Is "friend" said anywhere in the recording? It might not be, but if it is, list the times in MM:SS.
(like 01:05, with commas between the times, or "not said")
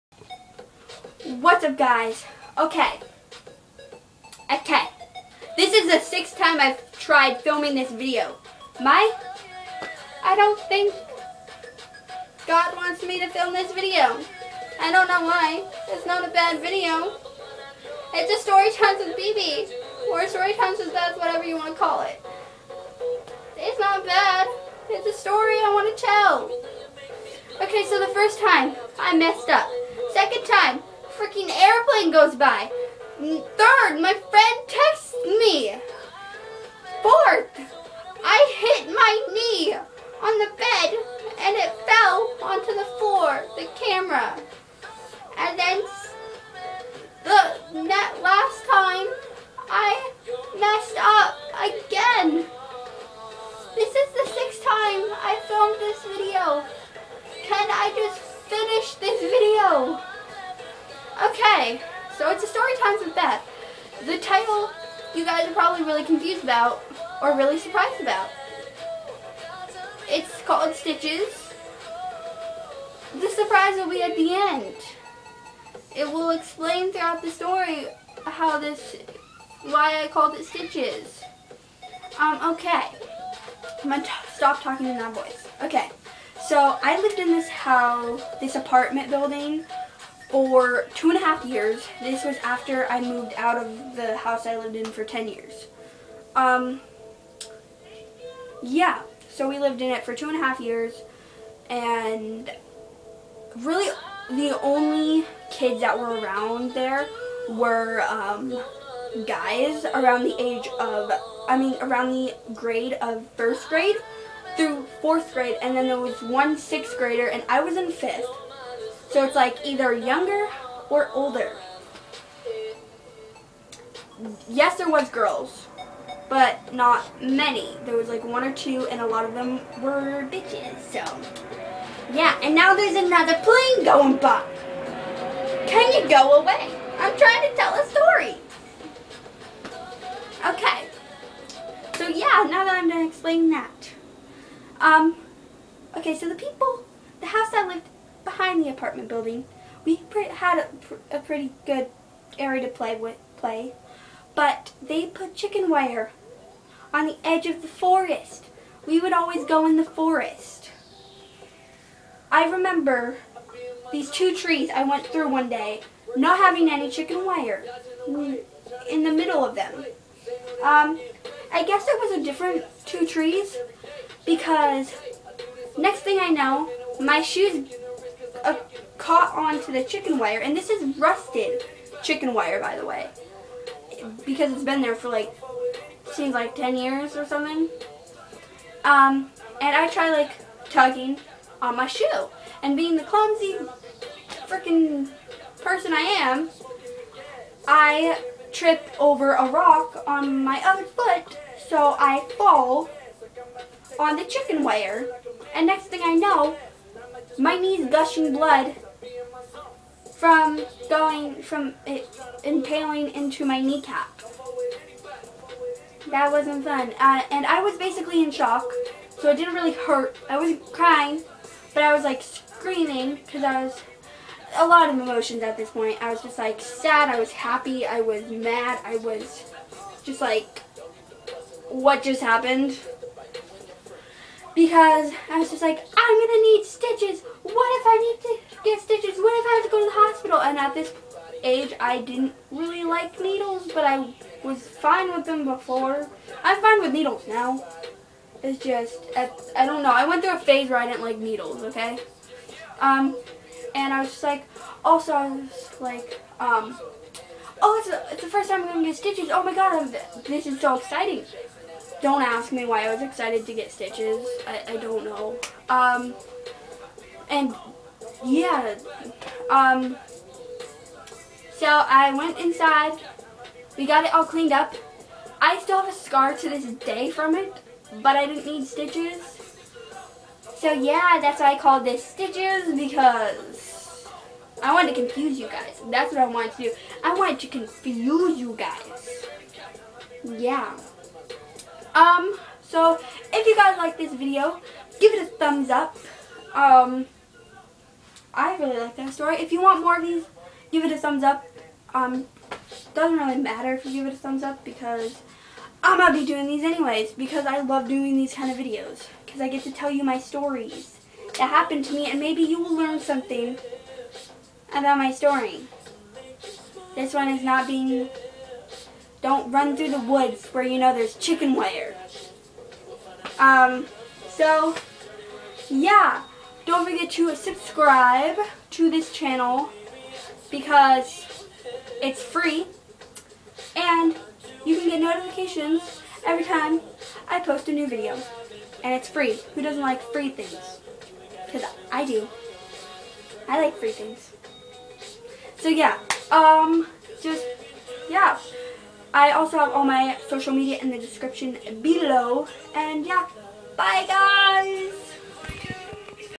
00:34.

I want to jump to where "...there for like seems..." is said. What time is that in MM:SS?
03:04.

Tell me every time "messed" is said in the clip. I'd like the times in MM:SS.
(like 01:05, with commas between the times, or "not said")
00:29, 00:50.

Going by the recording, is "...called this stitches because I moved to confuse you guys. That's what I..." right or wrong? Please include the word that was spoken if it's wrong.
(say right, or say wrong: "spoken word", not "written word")
wrong: "wanted", not "moved".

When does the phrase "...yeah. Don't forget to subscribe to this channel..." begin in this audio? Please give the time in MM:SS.
05:25.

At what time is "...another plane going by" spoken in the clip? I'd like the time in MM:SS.
02:12.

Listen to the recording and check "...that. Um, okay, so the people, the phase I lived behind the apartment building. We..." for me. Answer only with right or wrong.
wrong.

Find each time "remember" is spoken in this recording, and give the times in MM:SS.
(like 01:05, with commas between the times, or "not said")
02:42.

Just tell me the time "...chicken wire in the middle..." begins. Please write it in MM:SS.
02:46.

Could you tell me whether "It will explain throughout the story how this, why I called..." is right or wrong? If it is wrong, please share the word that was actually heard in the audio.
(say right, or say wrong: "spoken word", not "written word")
right.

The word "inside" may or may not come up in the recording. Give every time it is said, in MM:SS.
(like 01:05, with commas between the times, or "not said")
04:32.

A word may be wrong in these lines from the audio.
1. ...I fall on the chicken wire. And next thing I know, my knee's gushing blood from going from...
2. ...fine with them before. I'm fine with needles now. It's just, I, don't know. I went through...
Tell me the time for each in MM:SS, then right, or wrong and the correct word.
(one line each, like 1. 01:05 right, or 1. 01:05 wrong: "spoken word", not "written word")
1. 03:21 right
2. 04:04 right.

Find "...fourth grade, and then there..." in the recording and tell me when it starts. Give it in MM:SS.
01:55.